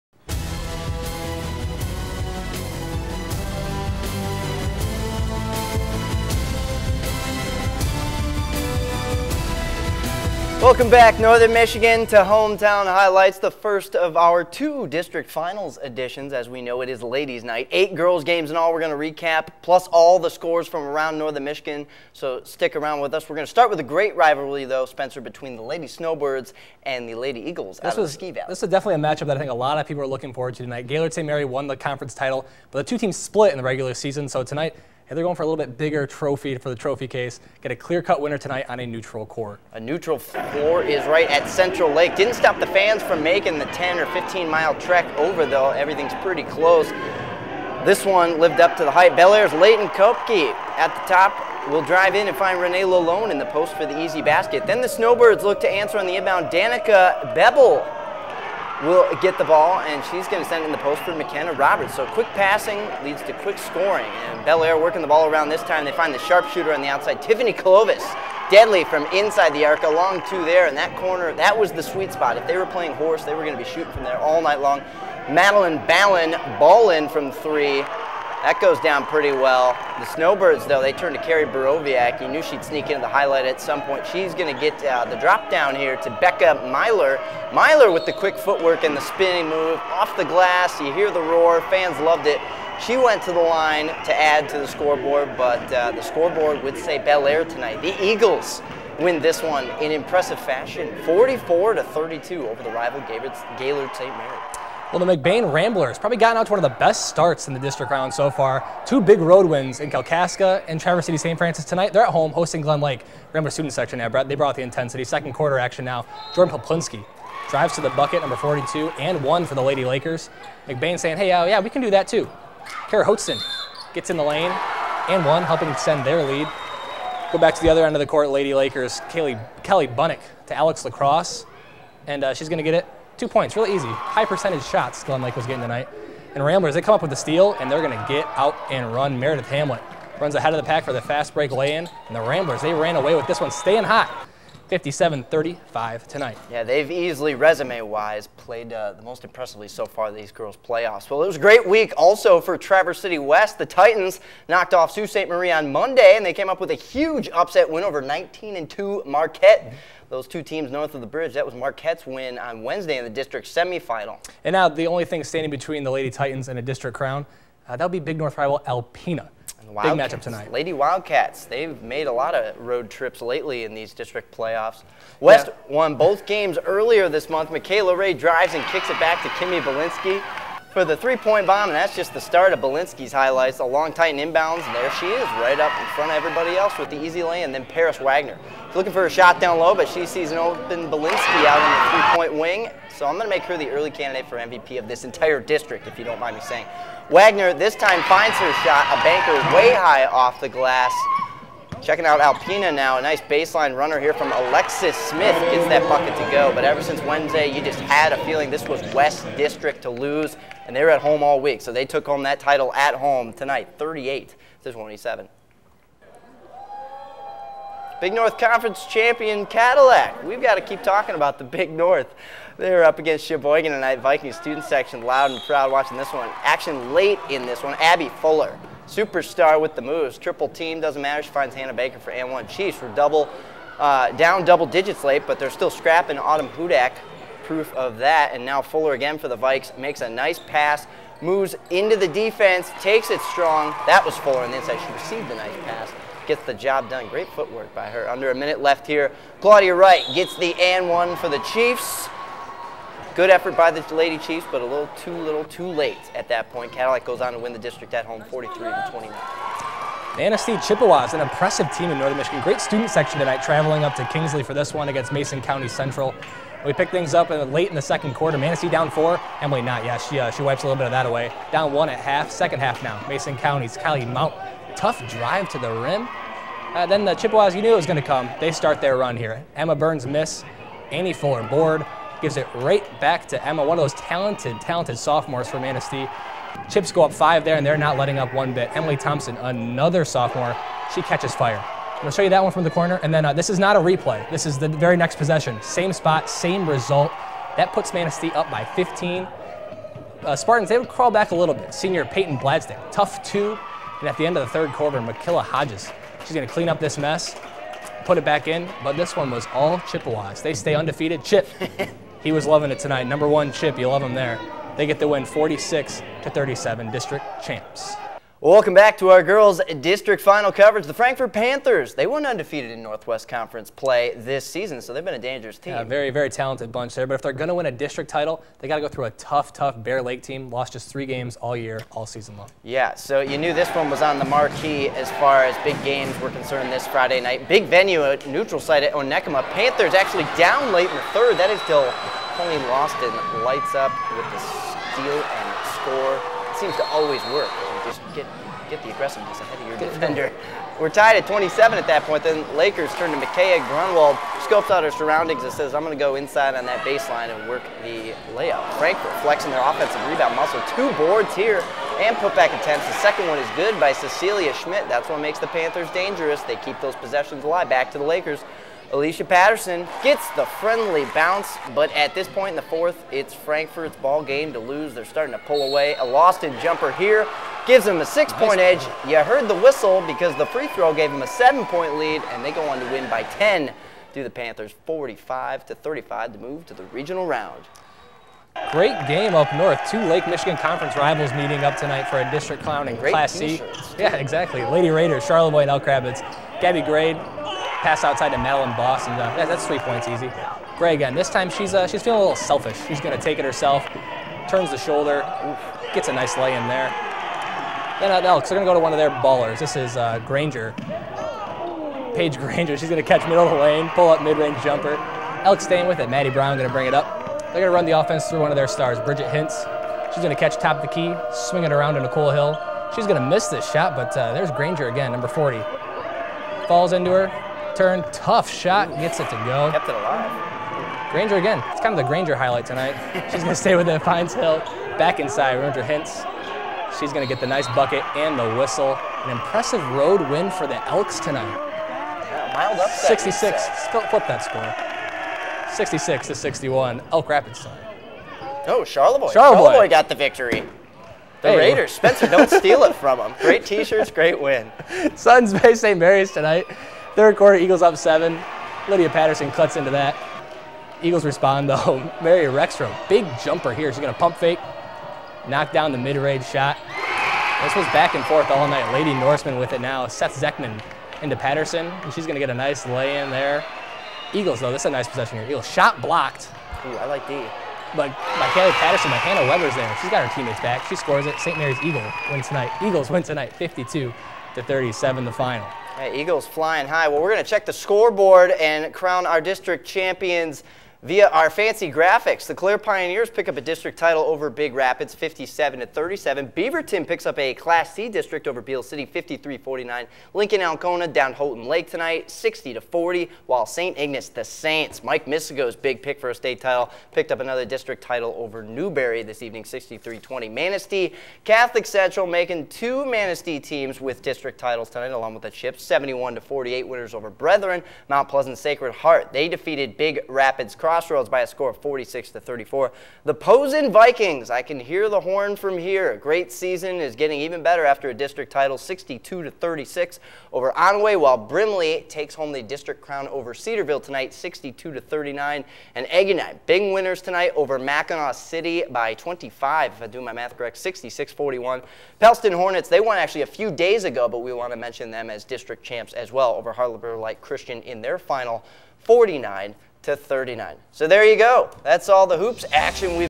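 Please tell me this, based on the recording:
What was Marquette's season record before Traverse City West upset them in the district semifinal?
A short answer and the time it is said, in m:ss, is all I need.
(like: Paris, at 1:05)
19-2, at 2:38.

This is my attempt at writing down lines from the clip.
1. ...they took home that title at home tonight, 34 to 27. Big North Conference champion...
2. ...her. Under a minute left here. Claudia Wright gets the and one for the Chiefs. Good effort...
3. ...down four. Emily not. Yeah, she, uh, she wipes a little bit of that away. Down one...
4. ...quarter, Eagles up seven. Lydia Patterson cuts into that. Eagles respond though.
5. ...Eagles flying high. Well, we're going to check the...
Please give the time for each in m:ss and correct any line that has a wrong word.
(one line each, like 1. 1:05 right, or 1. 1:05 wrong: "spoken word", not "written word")
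1. 3:31 wrong: "38", not "34"
2. 4:07 right
3. 4:28 right
4. 7:37 right
5. 8:06 right.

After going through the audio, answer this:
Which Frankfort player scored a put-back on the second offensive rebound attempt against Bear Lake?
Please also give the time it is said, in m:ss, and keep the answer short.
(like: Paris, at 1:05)
Cecilia Schmidt, at 6:03.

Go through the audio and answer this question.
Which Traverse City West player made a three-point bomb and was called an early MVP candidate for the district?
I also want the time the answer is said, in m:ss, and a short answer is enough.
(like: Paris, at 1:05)
Kimmy Balinski, at 2:59.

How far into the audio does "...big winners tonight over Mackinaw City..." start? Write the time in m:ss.
8:56.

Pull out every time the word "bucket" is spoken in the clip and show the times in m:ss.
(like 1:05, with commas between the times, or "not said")
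1:57, 3:25, 7:17.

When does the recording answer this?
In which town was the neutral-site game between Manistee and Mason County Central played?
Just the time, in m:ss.
4:24.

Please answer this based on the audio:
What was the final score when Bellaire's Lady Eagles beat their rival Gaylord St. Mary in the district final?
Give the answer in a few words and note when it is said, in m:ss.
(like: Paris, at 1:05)
44-32, at 1:41.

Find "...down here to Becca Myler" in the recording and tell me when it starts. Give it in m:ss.
1:25.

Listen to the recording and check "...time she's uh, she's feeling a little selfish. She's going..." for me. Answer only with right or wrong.
right.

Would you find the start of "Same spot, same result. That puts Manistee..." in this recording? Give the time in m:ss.
4:55.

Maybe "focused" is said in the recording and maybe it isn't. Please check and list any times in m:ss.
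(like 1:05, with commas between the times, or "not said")
not said.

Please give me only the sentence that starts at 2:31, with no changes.
Well, it was a great week also for Traverse City West.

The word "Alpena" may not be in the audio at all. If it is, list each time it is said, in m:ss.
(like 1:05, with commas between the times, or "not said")
2:48, 3:22.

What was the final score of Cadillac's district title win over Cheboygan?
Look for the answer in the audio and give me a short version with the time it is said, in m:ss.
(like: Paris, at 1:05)
43-29, at 4:18.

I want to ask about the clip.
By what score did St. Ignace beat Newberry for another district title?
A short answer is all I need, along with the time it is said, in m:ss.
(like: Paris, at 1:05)
63-20, at 8:29.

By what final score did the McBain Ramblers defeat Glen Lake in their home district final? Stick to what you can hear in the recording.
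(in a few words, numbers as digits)
57-35.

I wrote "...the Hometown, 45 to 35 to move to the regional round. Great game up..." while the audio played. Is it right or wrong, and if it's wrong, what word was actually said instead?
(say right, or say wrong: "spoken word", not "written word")
wrong: "Panthers", not "Hometown".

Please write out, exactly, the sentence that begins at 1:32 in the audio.
She went to the line to add to the scoreboard, but uh, the scoreboard would say Bellaire tonight.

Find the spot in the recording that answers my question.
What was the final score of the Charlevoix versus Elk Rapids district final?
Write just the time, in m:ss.
7:25.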